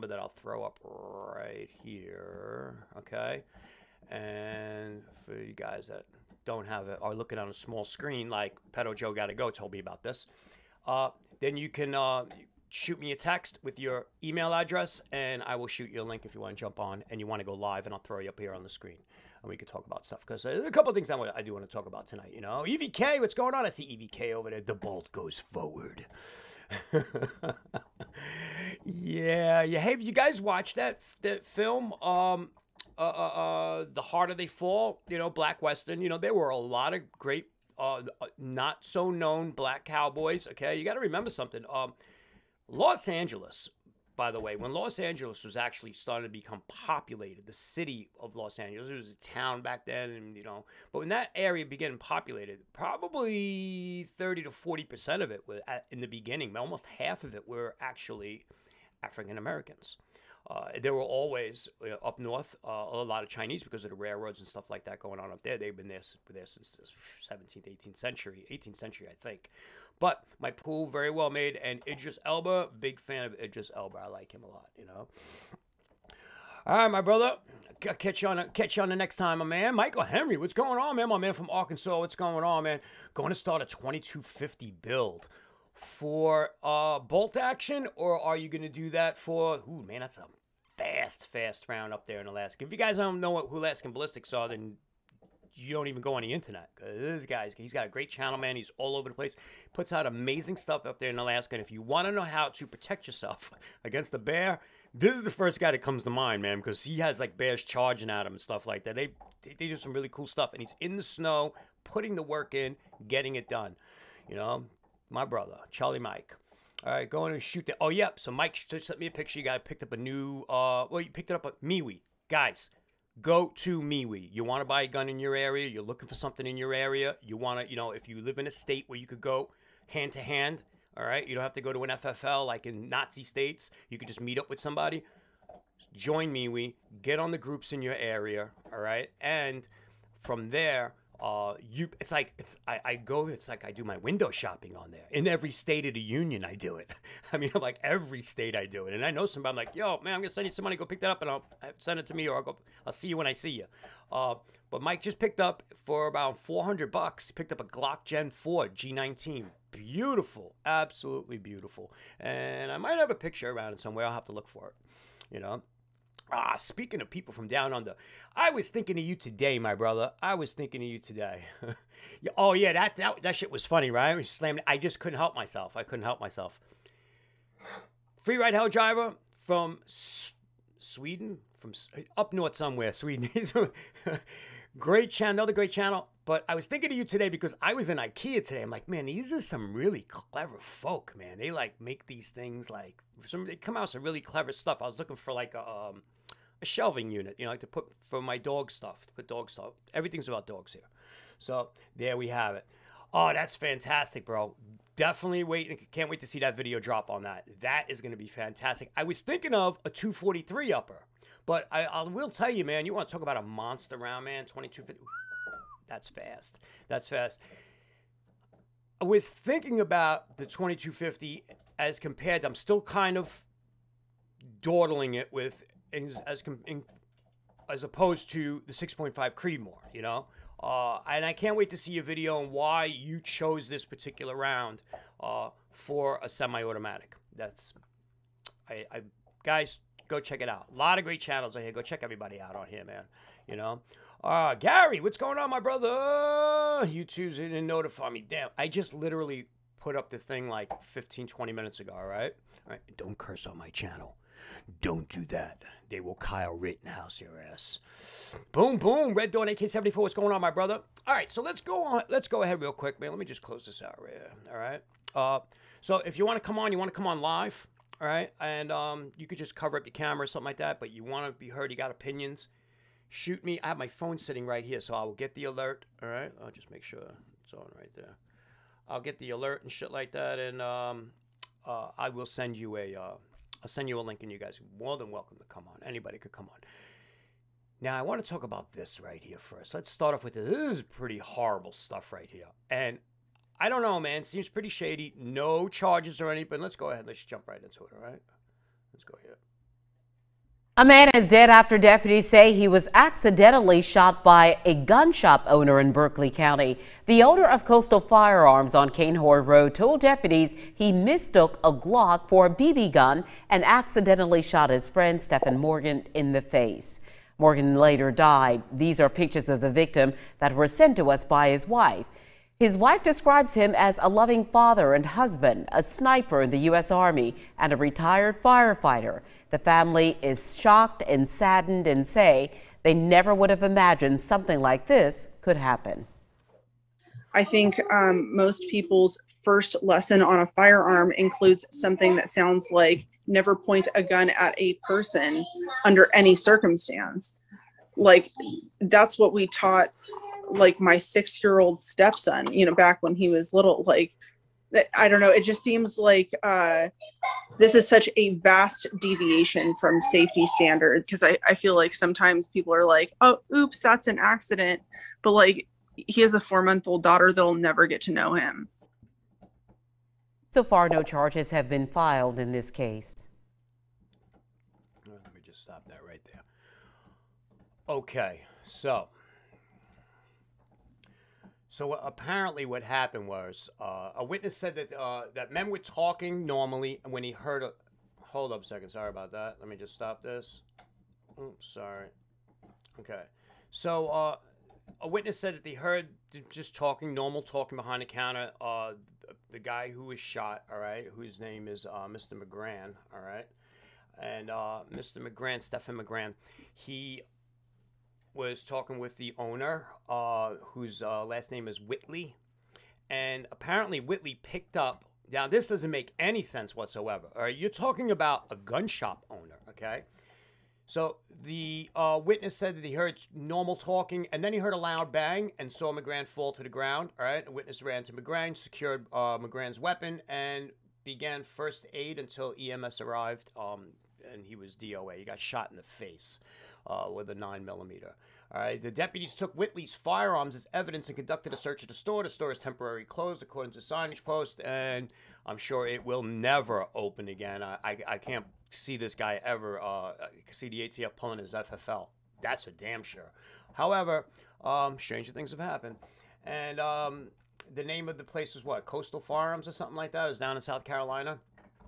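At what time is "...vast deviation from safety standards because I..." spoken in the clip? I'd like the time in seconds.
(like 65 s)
358 s.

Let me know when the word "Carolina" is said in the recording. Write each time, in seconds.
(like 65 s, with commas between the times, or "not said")
460 s.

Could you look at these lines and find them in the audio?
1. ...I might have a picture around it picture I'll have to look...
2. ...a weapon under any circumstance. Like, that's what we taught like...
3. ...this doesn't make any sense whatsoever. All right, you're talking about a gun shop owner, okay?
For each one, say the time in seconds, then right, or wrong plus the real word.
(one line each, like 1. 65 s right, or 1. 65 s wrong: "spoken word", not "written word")
1. 162 s wrong: "somewhere", not "picture"
2. 344 s wrong: "person", not "weapon"
3. 415 s right.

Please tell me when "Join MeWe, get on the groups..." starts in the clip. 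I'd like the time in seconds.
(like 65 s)
135 s.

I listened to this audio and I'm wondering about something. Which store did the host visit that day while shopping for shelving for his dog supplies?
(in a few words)
IKEA.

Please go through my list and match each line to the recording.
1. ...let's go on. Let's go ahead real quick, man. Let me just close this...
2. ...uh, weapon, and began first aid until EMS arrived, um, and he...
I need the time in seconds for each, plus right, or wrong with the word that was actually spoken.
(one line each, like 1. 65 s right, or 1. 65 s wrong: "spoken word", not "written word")
1. 261 s right
2. 429 s right.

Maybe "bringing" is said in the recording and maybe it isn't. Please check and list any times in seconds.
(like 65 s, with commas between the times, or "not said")
not said.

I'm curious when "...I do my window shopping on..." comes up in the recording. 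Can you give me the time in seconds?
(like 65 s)
143 s.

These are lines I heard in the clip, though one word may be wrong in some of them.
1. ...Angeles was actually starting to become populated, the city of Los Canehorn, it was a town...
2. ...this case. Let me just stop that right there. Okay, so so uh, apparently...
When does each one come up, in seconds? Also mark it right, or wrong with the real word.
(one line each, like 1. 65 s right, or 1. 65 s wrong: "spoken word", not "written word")
1. 44 s wrong: "Angeles", not "Canehorn"
2. 372 s right.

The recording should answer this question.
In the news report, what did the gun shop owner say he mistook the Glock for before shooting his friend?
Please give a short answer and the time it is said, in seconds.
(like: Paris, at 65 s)
A BB gun, at 312 s.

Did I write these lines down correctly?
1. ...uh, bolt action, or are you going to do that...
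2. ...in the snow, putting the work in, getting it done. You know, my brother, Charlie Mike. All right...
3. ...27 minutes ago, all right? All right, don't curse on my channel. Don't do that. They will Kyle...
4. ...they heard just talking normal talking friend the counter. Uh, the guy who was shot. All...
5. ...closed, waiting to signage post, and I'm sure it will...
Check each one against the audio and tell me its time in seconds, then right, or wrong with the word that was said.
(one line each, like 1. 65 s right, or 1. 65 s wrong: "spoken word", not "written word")
1. 86 s right
2. 110 s right
3. 251 s wrong: "20", not "27"
4. 395 s wrong: "behind", not "friend"
5. 443 s wrong: "according", not "waiting".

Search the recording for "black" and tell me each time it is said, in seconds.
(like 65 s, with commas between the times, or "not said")
35 s, 39 s.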